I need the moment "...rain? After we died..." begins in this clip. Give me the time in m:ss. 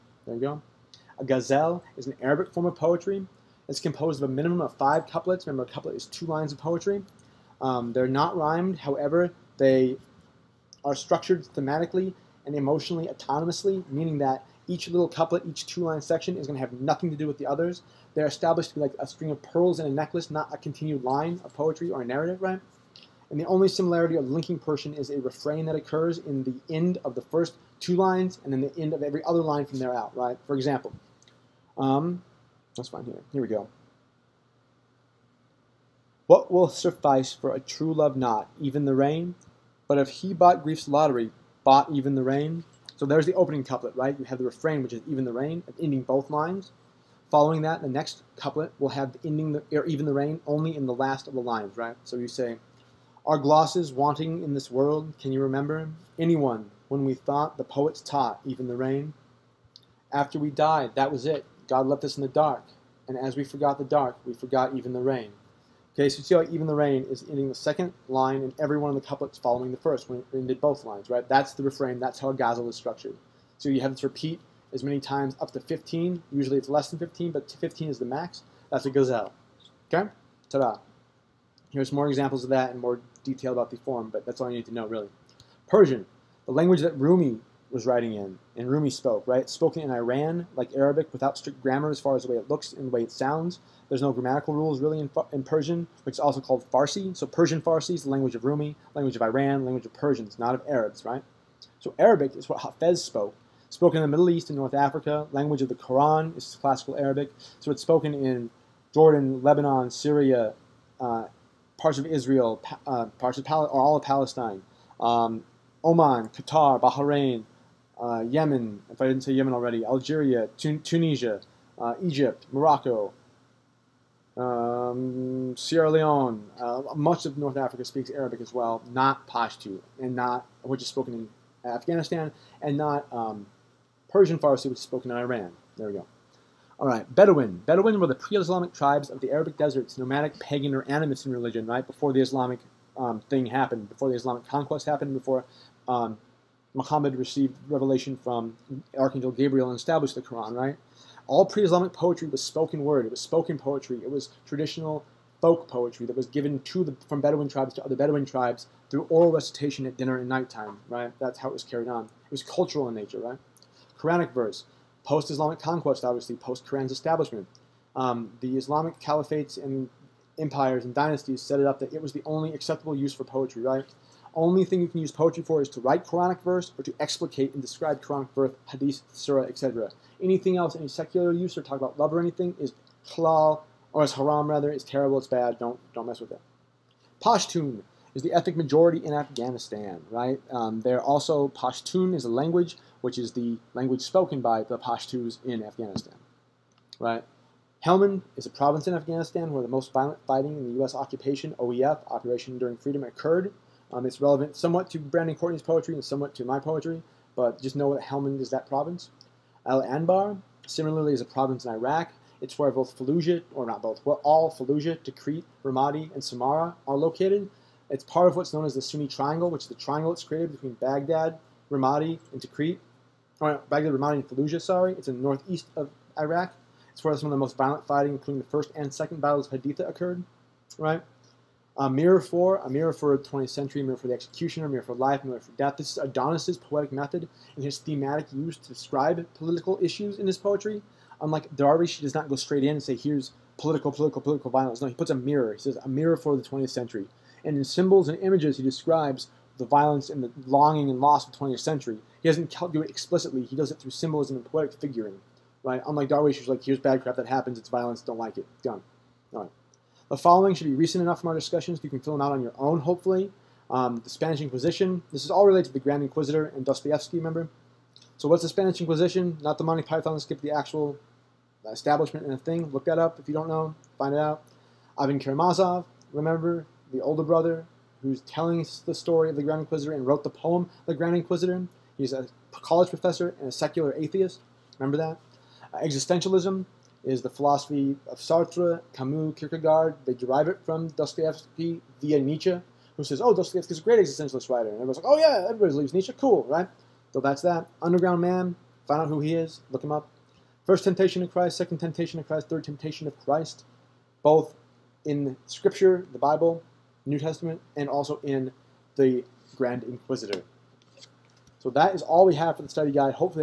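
0:58.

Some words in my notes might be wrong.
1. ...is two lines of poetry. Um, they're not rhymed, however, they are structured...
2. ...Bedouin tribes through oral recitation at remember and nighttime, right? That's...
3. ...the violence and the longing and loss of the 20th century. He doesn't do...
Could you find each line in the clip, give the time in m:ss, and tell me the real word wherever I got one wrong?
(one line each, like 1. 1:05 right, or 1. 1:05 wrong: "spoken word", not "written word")
1. 0:05 right
2. 2:37 wrong: "dinner", not "remember"
3. 4:09 right.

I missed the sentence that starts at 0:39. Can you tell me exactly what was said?
But if he bought grief's lottery, bought even the rain, so there's the opening couplet, right?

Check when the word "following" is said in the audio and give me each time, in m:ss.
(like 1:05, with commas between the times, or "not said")
0:47, 1:09, 4:20.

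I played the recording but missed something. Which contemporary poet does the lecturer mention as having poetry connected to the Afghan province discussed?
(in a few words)
Brandon Courtney.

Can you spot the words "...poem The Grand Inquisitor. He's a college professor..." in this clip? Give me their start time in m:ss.
4:40.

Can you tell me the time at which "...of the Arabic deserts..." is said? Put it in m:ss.
2:19.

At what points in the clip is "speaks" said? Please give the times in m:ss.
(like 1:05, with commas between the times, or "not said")
2:07.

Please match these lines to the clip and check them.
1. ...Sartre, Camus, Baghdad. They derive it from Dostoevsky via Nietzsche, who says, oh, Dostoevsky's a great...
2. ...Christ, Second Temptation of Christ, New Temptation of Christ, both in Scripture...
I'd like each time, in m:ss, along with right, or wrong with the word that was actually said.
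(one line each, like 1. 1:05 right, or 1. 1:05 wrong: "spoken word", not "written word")
1. 4:48 wrong: "Kierkegaard", not "Baghdad"
2. 5:01 wrong: "Third", not "New".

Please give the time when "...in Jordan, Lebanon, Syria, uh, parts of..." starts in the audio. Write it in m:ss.
1:48.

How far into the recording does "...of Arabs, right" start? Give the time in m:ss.
1:40.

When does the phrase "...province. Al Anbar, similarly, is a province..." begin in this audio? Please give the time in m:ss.
3:28.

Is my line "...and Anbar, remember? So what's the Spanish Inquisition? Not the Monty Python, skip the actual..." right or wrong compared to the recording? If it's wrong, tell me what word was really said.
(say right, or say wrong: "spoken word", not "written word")
wrong: "Dostoevsky", not "Anbar".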